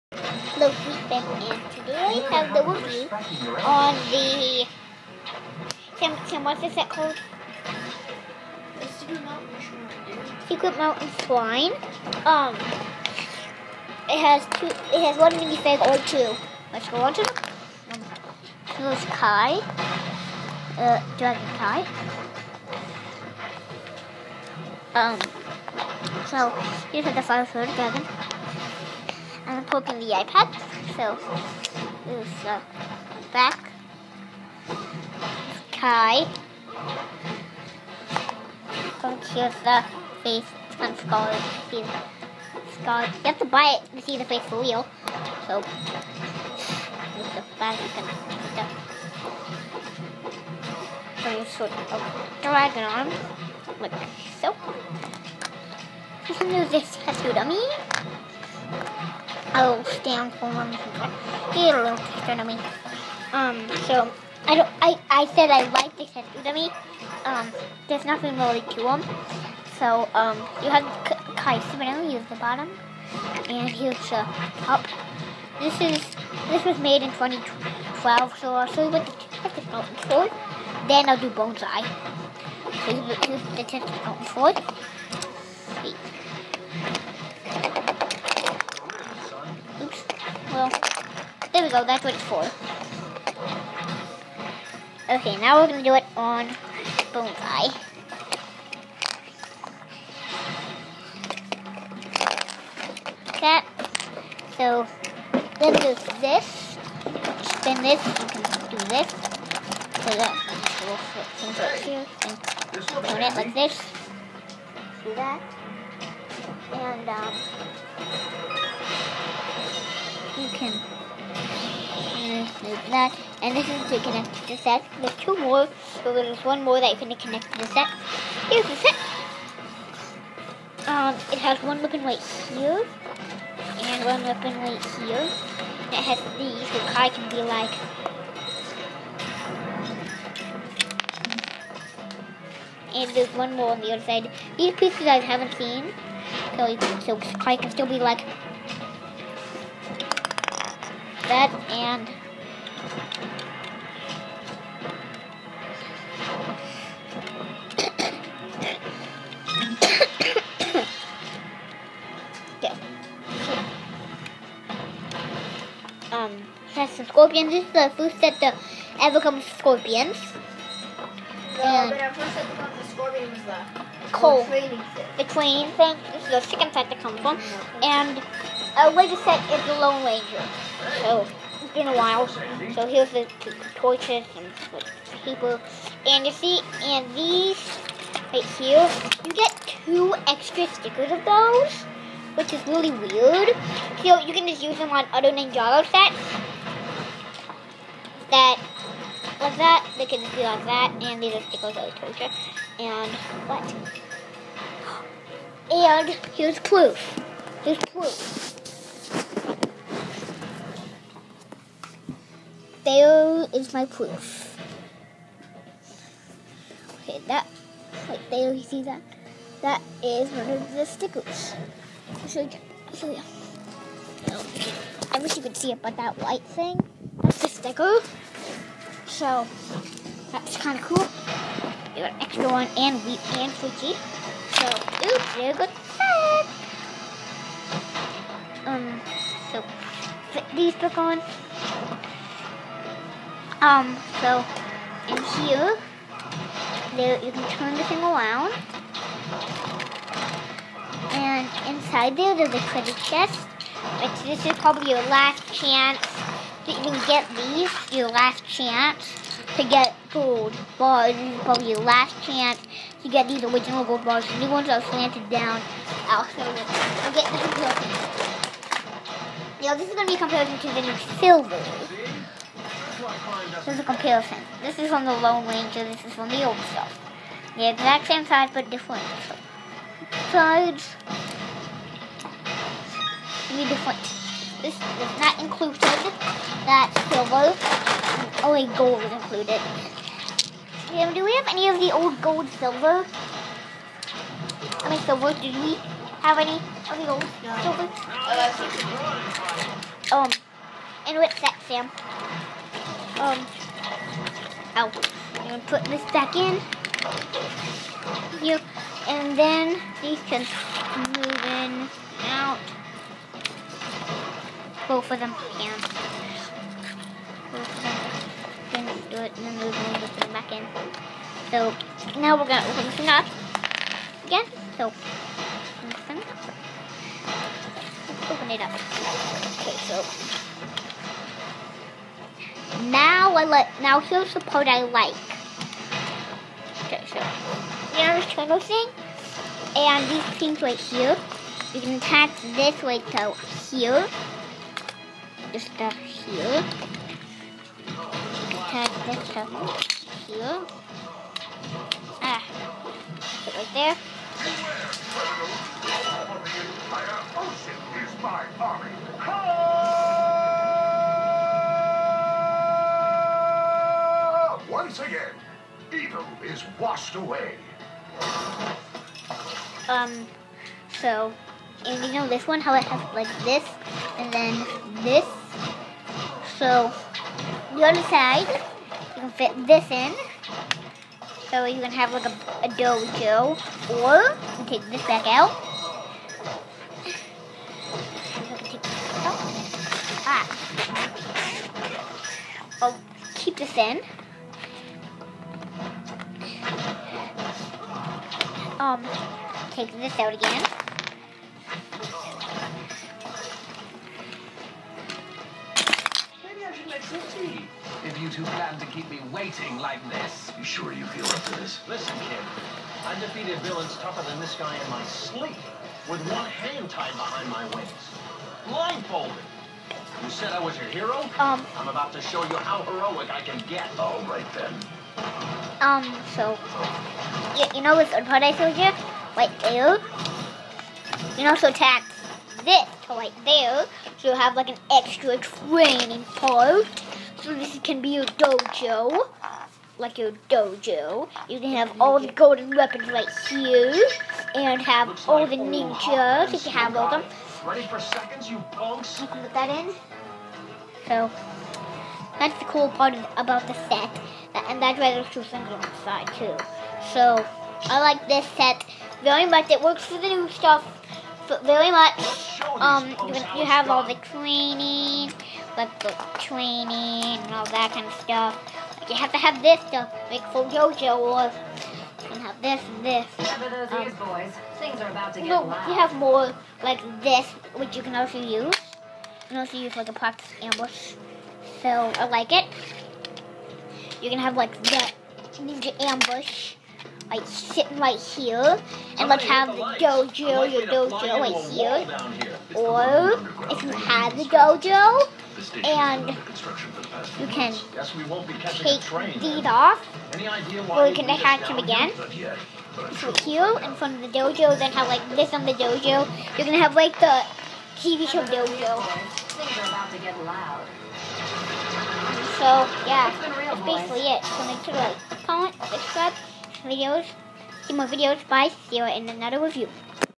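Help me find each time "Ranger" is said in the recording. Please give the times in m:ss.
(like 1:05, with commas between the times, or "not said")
3:00, 4:35.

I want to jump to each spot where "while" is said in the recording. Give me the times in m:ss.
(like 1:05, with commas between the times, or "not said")
3:01.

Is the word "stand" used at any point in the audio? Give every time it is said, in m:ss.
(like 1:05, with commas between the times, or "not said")
1:00.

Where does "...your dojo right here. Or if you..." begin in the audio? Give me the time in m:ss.
8:10.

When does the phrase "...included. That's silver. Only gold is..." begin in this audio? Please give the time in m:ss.
4:45.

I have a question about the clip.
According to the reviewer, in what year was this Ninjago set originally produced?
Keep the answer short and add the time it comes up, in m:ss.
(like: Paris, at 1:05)
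2012, at 1:17.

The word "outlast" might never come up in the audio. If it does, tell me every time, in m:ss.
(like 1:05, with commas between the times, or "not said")
not said.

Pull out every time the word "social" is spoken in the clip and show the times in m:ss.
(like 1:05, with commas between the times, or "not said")
not said.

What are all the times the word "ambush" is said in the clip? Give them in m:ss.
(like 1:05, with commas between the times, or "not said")
8:00, 8:05.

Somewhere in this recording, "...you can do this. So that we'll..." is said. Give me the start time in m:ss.
1:48.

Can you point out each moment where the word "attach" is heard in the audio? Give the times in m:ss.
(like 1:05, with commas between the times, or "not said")
5:41, 5:48, 7:11, 8:21.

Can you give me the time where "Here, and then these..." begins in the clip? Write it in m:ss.
5:08.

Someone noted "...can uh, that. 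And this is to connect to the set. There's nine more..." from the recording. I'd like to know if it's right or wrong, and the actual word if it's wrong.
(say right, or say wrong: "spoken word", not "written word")
wrong: "two", not "nine".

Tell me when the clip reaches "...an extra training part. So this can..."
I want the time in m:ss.
7:14.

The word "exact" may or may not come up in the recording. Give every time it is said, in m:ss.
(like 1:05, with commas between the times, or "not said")
4:37.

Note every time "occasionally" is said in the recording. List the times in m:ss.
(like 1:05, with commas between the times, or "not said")
not said.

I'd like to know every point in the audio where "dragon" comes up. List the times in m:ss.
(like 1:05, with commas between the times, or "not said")
0:21, 0:27, 0:52.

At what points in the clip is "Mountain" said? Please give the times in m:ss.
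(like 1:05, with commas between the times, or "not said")
0:10, 1:19, 1:24.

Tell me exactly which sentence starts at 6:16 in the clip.
So, the other side, you can fit this in.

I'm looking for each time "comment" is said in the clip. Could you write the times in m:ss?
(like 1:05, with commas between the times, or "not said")
8:35.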